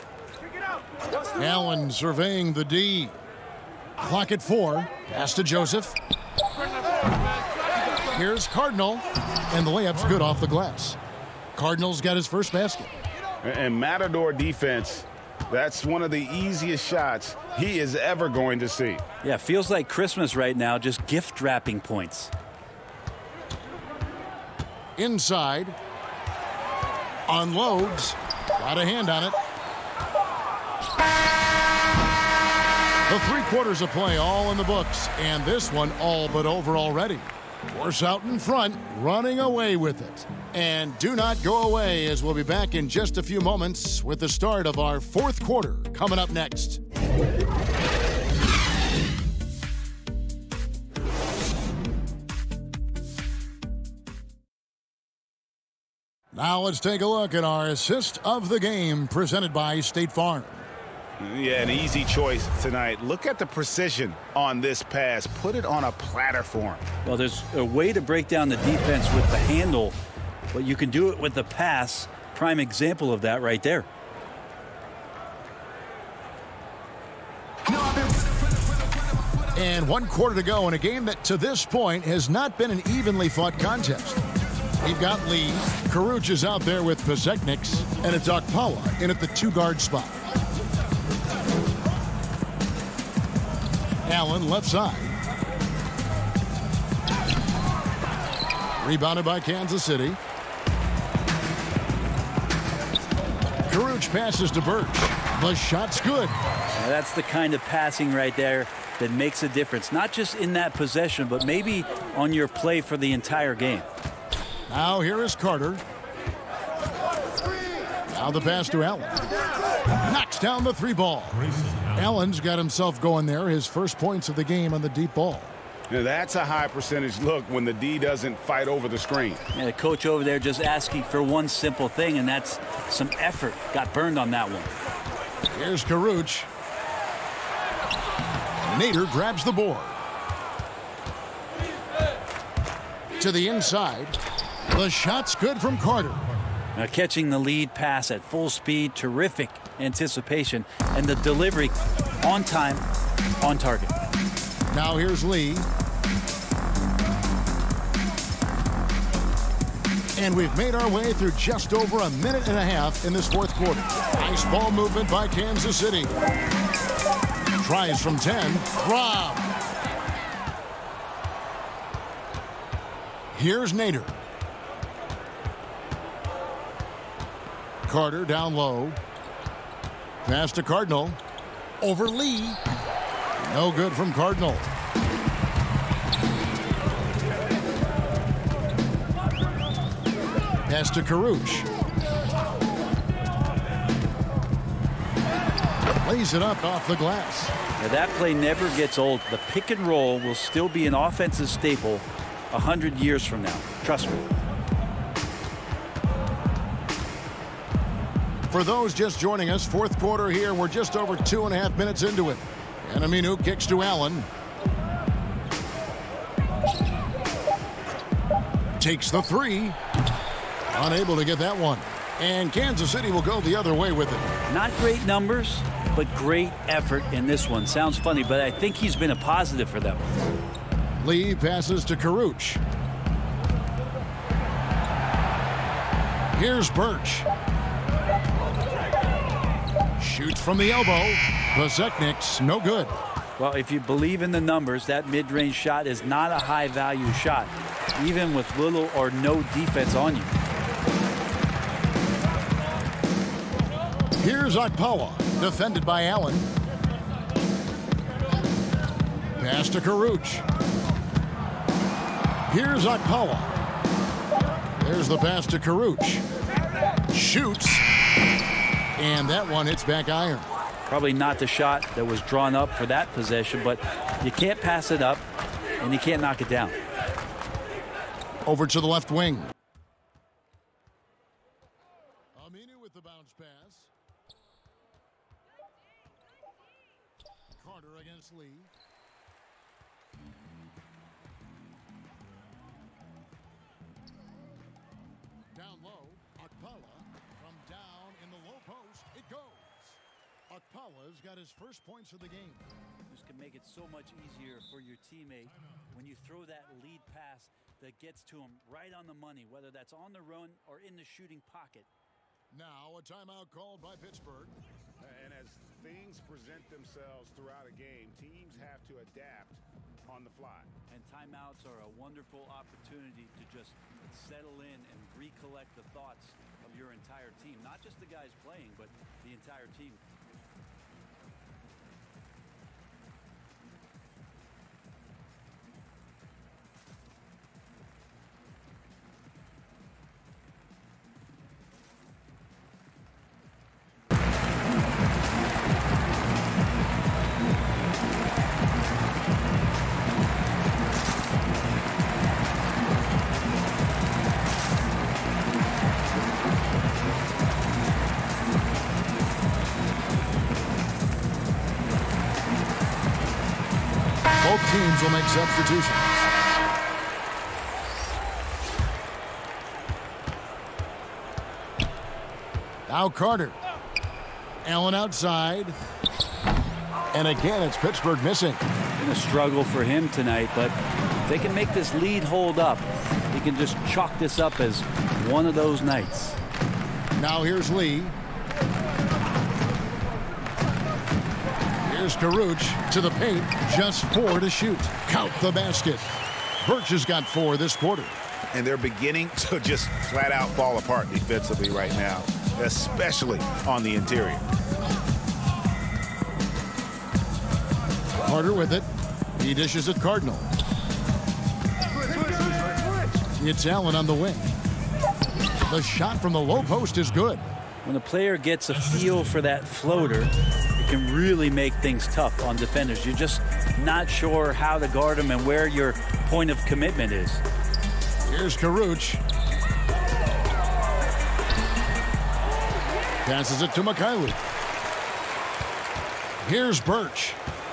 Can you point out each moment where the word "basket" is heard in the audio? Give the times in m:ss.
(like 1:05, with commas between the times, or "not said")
0:12, 6:35.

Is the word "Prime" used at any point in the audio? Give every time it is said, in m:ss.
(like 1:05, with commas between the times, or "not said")
1:12.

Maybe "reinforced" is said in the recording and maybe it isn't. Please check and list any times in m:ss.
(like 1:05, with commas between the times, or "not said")
not said.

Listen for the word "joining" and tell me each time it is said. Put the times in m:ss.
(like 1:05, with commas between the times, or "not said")
3:29.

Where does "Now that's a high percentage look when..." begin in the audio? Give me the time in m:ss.
2:05.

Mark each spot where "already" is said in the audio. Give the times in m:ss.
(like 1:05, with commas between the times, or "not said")
0:36.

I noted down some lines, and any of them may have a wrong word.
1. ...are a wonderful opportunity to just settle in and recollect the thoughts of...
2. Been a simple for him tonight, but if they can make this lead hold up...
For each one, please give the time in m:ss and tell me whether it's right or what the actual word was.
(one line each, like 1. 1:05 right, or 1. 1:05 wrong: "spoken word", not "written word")
1. 5:21 right
2. 6:18 wrong: "struggle", not "simple".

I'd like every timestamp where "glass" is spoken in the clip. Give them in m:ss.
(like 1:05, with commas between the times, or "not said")
0:10, 3:16.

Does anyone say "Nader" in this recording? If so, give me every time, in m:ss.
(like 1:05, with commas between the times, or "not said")
2:18, 2:53.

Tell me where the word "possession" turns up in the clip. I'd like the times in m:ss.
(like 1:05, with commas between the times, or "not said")
1:50, 4:33.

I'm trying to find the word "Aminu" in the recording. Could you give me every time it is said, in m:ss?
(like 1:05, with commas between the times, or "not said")
3:33, 4:42.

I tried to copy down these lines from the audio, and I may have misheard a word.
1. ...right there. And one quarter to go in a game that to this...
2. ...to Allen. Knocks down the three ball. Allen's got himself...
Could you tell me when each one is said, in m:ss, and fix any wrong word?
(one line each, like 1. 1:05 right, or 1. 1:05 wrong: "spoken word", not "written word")
1. 1:13 right
2. 1:58 right.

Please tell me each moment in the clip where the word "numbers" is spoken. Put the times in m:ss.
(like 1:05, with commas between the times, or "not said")
3:45, 4:04.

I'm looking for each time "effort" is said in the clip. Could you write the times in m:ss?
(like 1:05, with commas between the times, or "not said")
2:13, 3:46.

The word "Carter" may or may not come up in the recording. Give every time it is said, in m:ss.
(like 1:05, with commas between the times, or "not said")
1:55, 2:25, 2:57, 4:47, 6:13, 6:48.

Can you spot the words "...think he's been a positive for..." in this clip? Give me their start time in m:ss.
3:48.